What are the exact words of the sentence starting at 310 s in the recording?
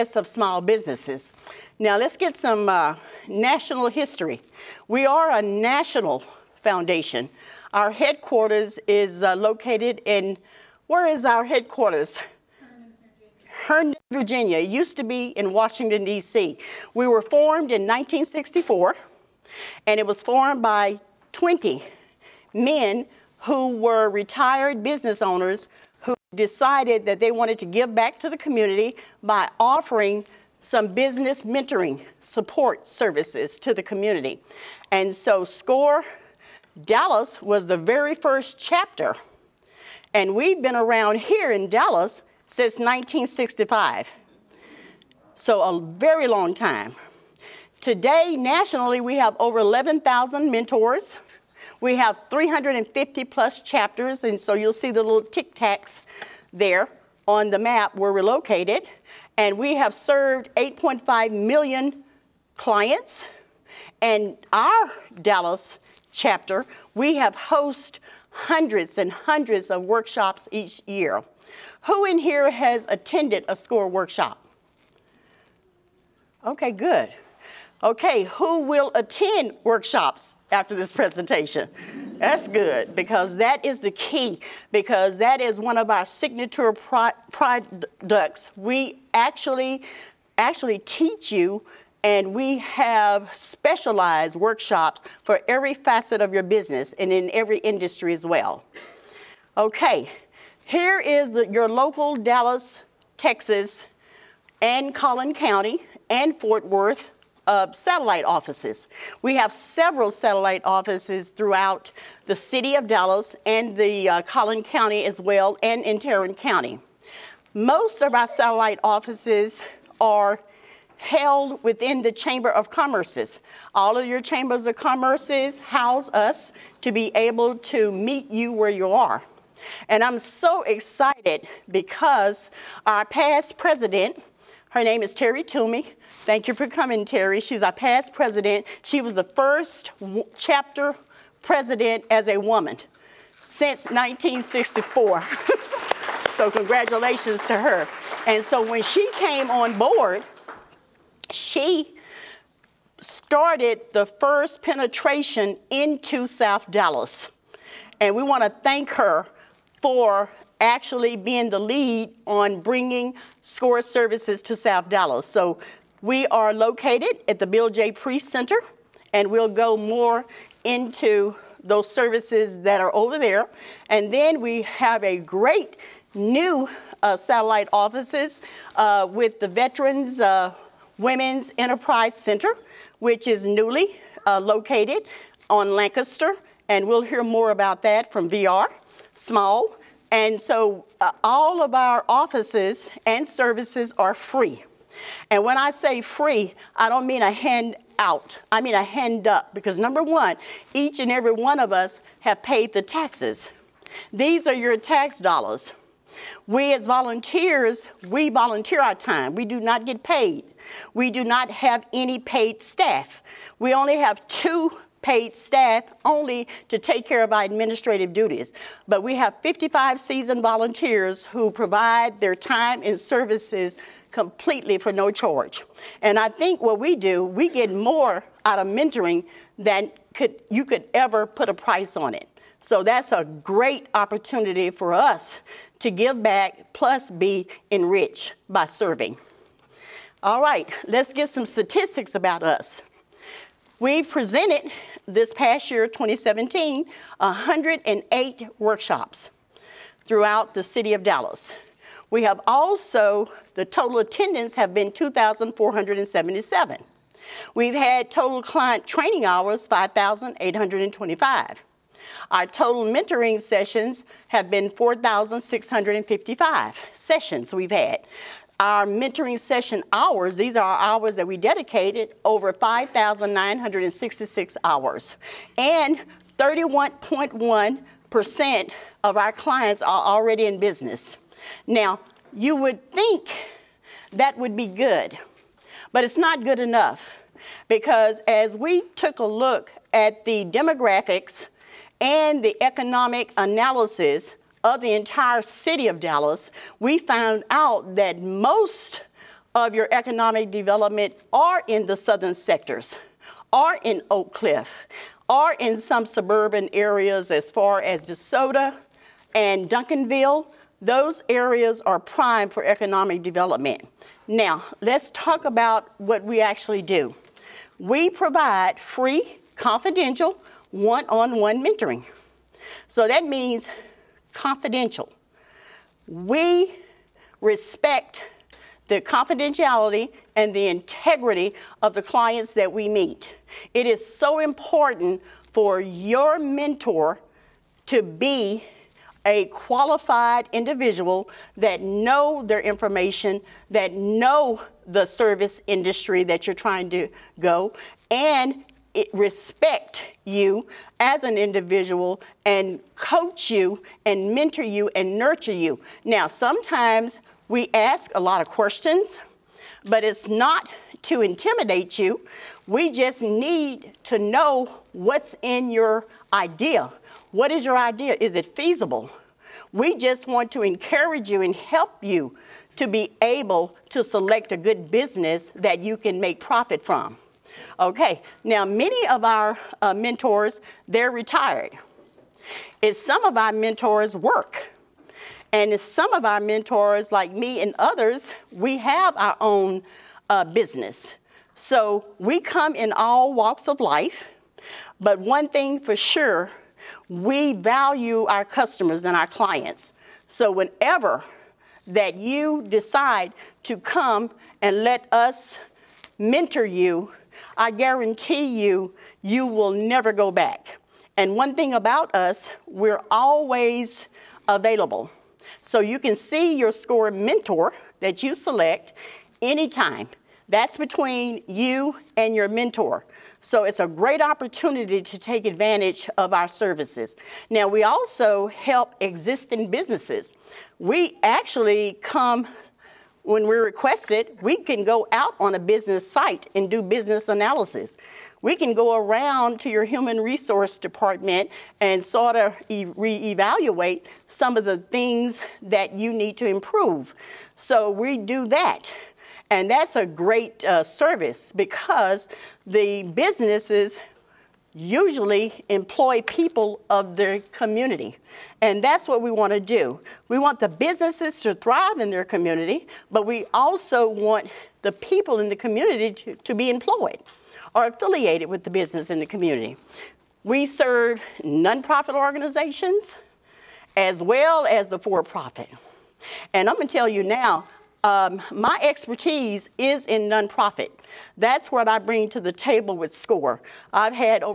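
Those areas are prime for economic development.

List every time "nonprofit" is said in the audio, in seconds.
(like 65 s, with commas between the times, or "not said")
471 s, 480 s.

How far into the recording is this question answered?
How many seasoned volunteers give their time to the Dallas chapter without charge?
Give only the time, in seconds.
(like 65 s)
219 s.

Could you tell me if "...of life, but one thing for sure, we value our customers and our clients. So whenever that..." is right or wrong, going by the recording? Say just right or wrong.
right.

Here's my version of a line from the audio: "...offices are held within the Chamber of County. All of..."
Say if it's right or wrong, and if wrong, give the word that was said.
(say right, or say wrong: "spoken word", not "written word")
wrong: "Commerces", not "County".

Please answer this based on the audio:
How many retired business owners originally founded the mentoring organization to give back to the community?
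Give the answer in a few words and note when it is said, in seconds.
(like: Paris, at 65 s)
20, at 21 s.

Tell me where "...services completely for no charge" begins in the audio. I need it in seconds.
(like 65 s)
222 s.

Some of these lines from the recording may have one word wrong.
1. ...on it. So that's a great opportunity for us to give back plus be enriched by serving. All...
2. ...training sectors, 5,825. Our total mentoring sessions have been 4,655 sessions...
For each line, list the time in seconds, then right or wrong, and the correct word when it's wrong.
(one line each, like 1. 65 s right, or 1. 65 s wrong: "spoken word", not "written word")
1. 231 s right
2. 258 s wrong: "hours", not "sectors".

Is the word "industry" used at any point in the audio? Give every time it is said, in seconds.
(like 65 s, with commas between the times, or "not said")
97 s, 345 s.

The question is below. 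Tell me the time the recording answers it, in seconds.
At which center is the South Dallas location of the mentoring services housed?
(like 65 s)
167 s.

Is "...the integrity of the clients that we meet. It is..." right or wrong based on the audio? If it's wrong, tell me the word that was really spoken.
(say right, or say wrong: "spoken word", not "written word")
right.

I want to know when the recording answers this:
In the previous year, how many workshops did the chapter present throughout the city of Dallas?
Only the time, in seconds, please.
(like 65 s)
247 s.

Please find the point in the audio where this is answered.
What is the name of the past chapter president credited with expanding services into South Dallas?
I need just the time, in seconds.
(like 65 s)
135 s.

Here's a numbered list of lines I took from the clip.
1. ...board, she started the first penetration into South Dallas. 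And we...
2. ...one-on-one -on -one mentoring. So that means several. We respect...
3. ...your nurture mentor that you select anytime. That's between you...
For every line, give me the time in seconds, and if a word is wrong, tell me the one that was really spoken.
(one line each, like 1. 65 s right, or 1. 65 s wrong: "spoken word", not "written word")
1. 149 s right
2. 320 s wrong: "confidential", not "several"
3. 416 s wrong: "score", not "nurture".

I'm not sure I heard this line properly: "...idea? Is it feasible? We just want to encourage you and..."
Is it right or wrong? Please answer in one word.
right.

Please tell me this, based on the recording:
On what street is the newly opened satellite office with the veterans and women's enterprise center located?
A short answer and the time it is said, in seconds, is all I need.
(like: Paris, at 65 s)
Lancaster, at 185 s.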